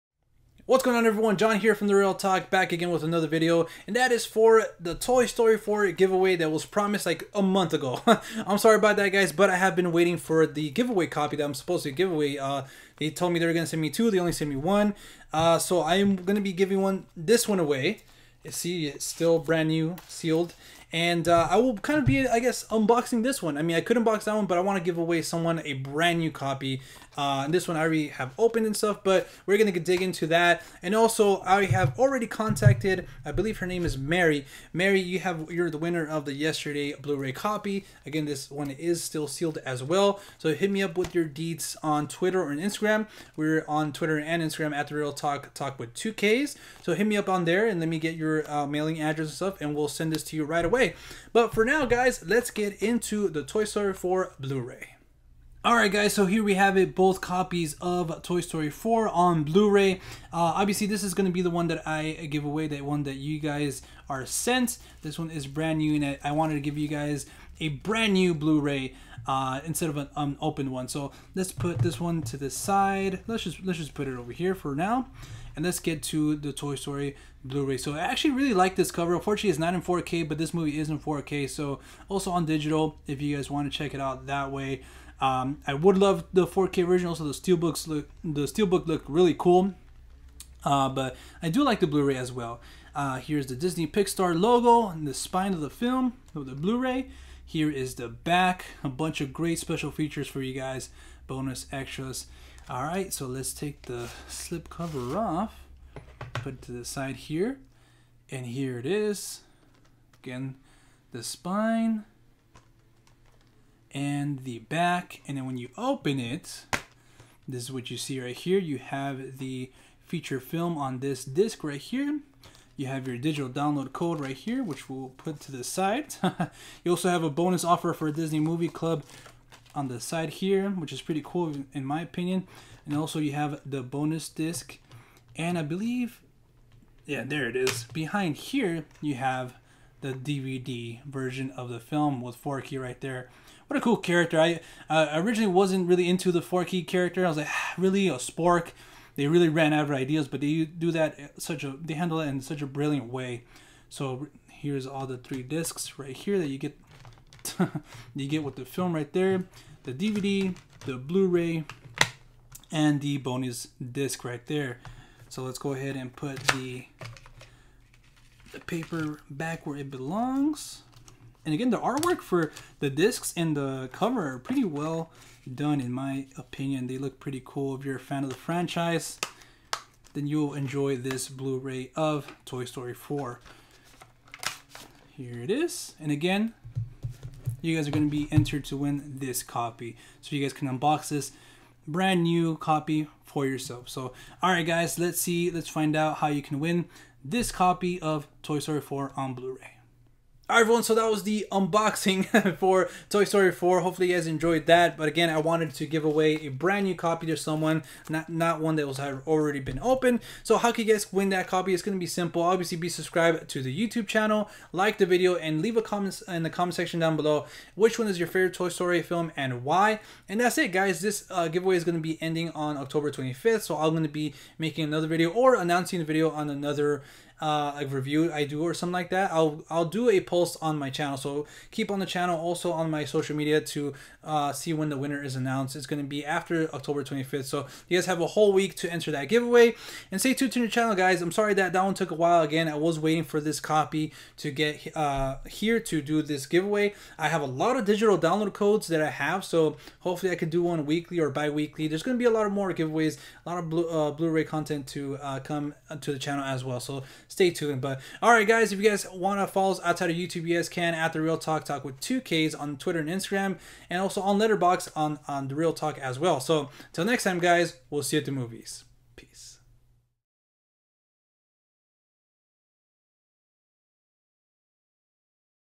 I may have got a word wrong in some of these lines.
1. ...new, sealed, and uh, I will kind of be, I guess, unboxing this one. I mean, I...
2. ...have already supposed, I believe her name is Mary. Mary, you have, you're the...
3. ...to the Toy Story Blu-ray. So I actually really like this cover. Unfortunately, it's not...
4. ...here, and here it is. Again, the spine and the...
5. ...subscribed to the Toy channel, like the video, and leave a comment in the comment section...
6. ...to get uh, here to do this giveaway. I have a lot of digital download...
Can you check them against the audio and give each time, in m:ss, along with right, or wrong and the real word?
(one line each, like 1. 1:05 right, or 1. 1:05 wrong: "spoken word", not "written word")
1. 0:19 right
2. 0:31 wrong: "contacted", not "supposed"
3. 1:16 right
4. 1:47 right
5. 3:32 wrong: "YouTube", not "Toy"
6. 4:04 right.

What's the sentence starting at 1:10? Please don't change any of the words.
So let's put this one to the side.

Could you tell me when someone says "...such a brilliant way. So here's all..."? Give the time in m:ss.
2:32.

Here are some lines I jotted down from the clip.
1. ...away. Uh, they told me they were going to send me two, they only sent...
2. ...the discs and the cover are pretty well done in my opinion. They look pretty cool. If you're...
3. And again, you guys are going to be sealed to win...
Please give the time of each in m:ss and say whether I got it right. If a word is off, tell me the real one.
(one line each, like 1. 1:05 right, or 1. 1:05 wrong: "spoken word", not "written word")
1. 0:12 right
2. 2:52 right
3. 3:05 wrong: "entered", not "sealed".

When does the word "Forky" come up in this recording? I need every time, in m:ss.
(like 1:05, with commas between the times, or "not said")
2:22, 2:26.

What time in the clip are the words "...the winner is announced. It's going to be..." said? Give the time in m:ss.
3:54.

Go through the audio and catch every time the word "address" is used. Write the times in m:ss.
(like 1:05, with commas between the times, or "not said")
0:49.